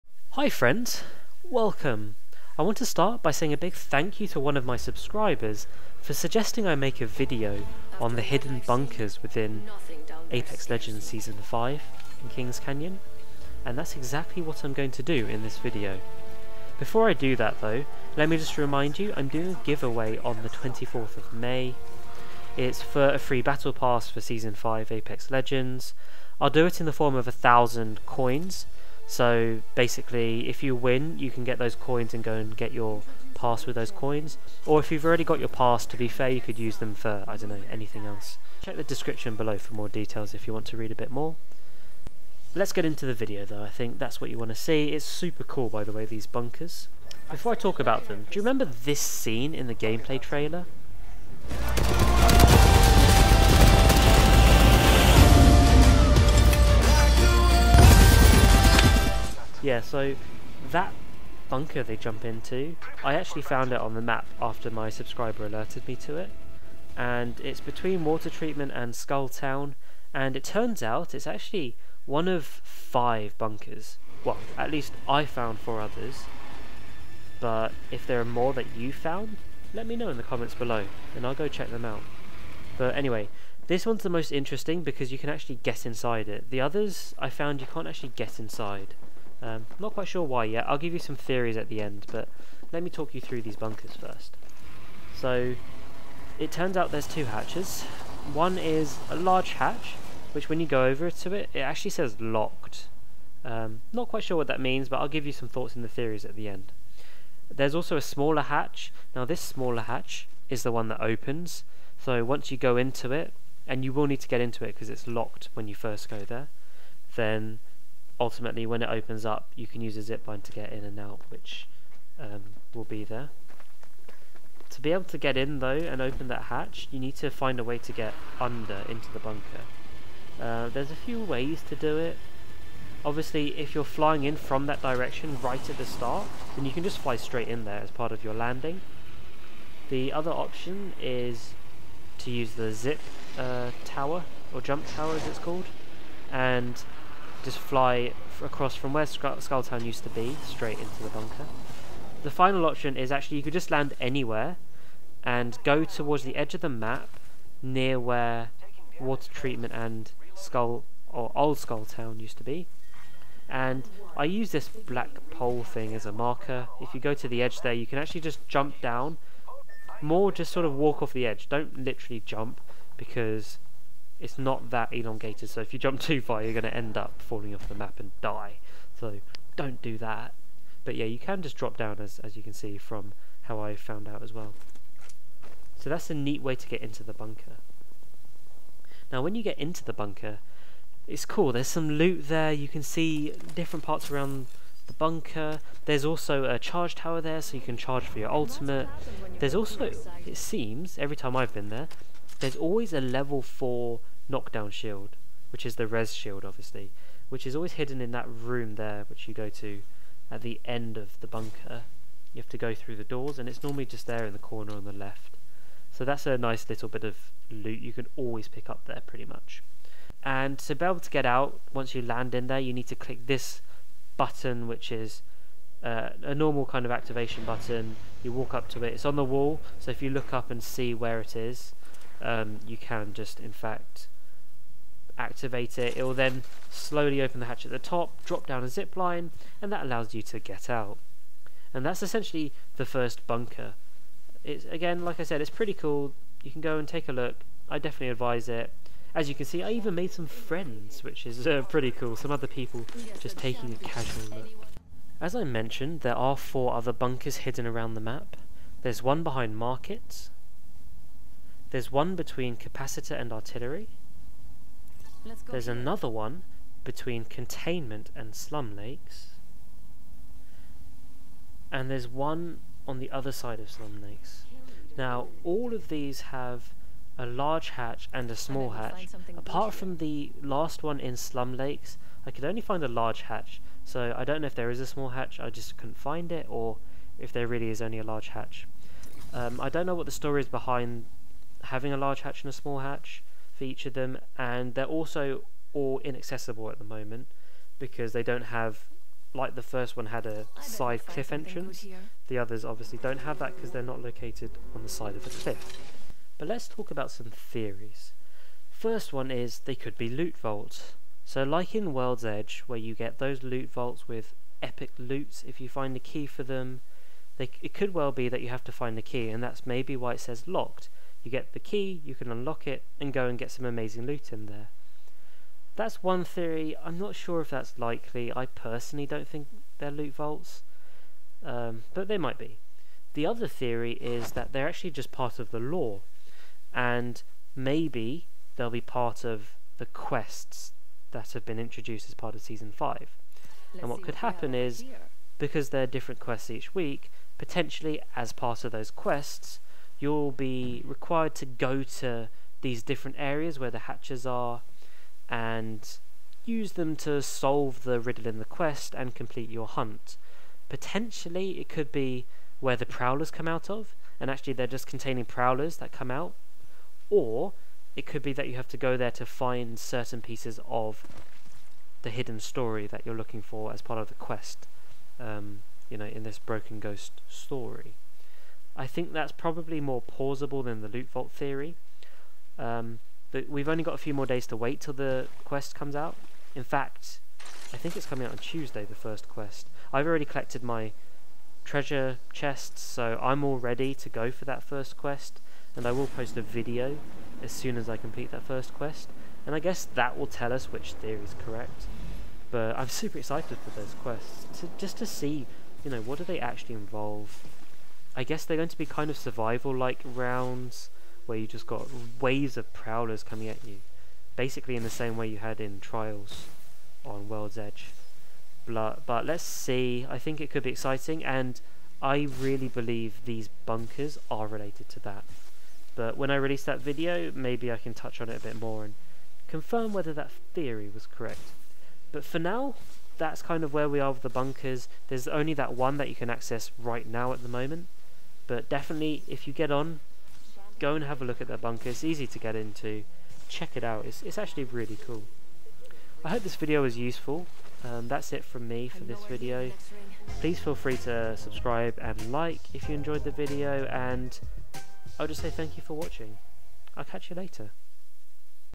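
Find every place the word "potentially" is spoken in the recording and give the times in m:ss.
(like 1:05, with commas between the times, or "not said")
5:47, 6:00.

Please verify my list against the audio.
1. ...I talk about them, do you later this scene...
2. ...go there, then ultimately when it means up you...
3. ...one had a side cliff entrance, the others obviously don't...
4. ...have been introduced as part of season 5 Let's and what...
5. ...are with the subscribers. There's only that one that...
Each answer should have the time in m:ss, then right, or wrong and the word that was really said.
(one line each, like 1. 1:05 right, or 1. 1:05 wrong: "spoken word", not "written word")
1. 0:47 wrong: "remember", not "later"
2. 1:56 wrong: "opens", not "means"
3. 4:59 right
4. 5:41 right
5. 7:13 wrong: "bunkers", not "subscribers".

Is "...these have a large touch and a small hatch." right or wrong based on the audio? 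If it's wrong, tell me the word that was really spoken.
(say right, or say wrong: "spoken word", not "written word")
wrong: "hatch", not "touch".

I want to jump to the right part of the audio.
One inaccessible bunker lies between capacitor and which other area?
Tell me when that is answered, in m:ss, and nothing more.
4:23.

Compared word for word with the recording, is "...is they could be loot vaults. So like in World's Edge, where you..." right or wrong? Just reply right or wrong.
right.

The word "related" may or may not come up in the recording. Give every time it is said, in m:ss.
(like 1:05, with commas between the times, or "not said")
7:04.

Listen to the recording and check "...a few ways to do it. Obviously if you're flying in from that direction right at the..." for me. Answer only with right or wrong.
right.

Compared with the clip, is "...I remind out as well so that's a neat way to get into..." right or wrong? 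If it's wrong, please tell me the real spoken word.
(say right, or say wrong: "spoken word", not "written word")
wrong: "found", not "remind".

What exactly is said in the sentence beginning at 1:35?
So, it turns out there's two hatches.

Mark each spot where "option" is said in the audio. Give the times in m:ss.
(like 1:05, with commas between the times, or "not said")
2:20, 2:32.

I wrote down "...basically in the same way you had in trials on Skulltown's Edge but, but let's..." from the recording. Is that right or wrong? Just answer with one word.
wrong.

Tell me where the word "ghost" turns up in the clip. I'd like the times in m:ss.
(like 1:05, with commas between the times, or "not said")
6:16.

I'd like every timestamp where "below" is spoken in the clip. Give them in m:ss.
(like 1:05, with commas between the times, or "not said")
0:39, 1:20.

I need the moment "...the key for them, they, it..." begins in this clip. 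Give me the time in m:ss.
5:15.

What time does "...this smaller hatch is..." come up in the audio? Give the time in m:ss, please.
1:49.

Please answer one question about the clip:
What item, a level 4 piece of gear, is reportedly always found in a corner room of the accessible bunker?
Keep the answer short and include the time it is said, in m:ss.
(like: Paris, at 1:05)
knockdown shield, at 3:24.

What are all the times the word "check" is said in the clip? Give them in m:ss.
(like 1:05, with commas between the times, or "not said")
0:38, 1:21, 7:23.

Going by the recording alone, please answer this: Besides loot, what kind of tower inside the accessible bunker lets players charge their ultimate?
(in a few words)
charge tower.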